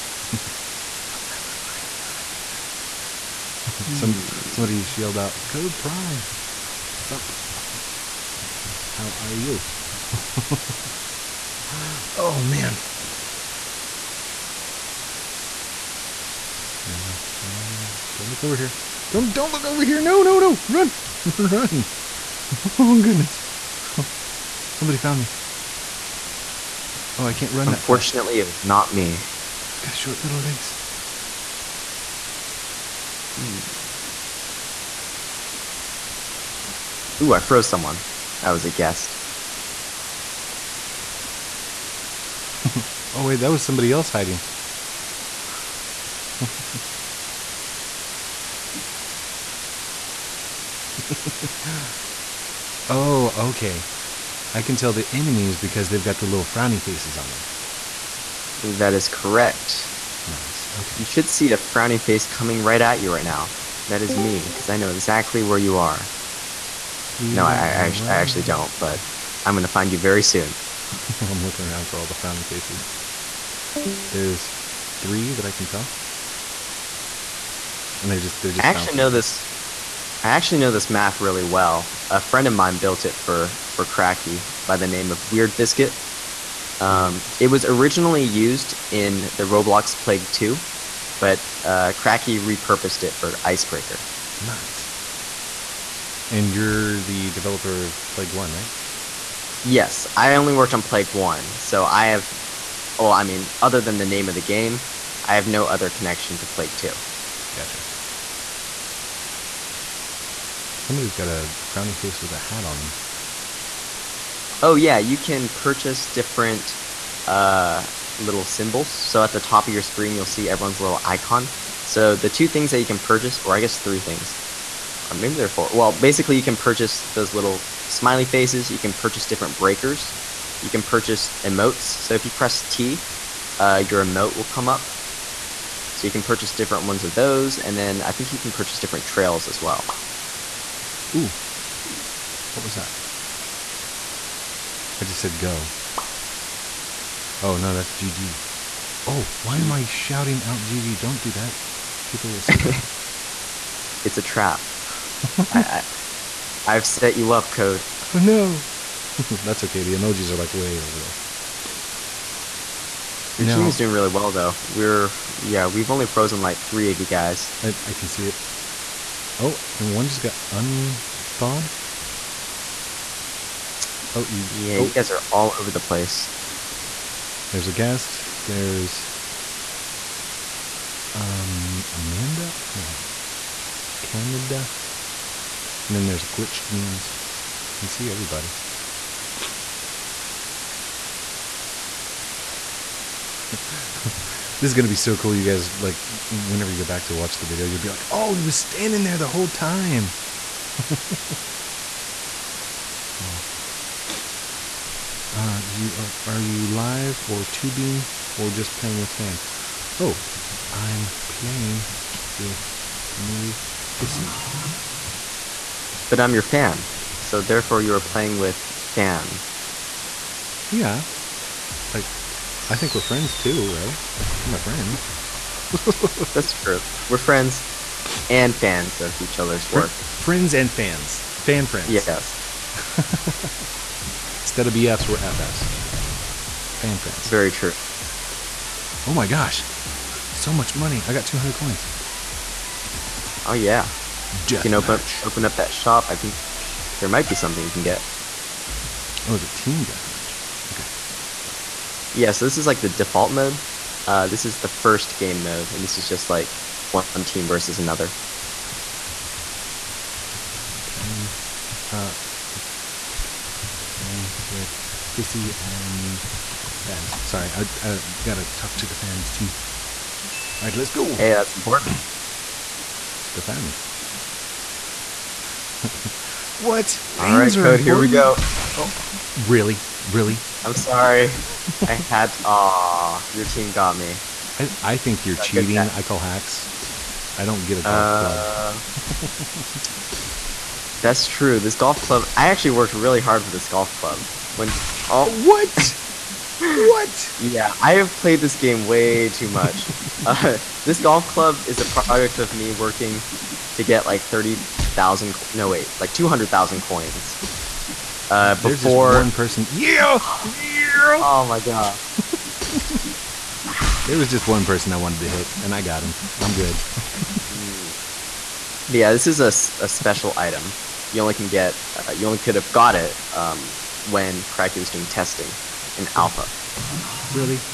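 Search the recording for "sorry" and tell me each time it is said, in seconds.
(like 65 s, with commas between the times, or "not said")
267 s, 280 s.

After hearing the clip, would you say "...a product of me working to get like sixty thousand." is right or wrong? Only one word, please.
wrong.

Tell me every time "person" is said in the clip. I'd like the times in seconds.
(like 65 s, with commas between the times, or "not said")
309 s, 314 s.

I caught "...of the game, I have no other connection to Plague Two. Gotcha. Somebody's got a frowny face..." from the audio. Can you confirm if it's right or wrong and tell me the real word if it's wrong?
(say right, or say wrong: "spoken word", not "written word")
right.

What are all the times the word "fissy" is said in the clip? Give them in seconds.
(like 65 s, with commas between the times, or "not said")
213 s, 265 s.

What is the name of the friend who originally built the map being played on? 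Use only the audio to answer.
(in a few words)
Weird Biscuit.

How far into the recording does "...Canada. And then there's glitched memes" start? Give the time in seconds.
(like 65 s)
184 s.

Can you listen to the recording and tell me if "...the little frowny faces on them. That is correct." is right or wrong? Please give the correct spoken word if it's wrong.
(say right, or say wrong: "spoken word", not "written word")
right.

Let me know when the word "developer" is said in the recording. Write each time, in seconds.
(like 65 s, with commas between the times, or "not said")
97 s.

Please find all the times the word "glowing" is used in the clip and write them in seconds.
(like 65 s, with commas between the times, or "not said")
not said.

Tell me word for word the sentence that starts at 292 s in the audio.
I actually worked really hard for this golf club.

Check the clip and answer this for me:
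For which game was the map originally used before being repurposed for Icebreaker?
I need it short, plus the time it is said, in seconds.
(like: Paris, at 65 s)
Roblox Plague 2, at 89 s.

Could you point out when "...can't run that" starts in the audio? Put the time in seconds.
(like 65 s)
27 s.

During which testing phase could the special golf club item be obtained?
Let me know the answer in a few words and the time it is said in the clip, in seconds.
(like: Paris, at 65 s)
Alpha, at 326 s.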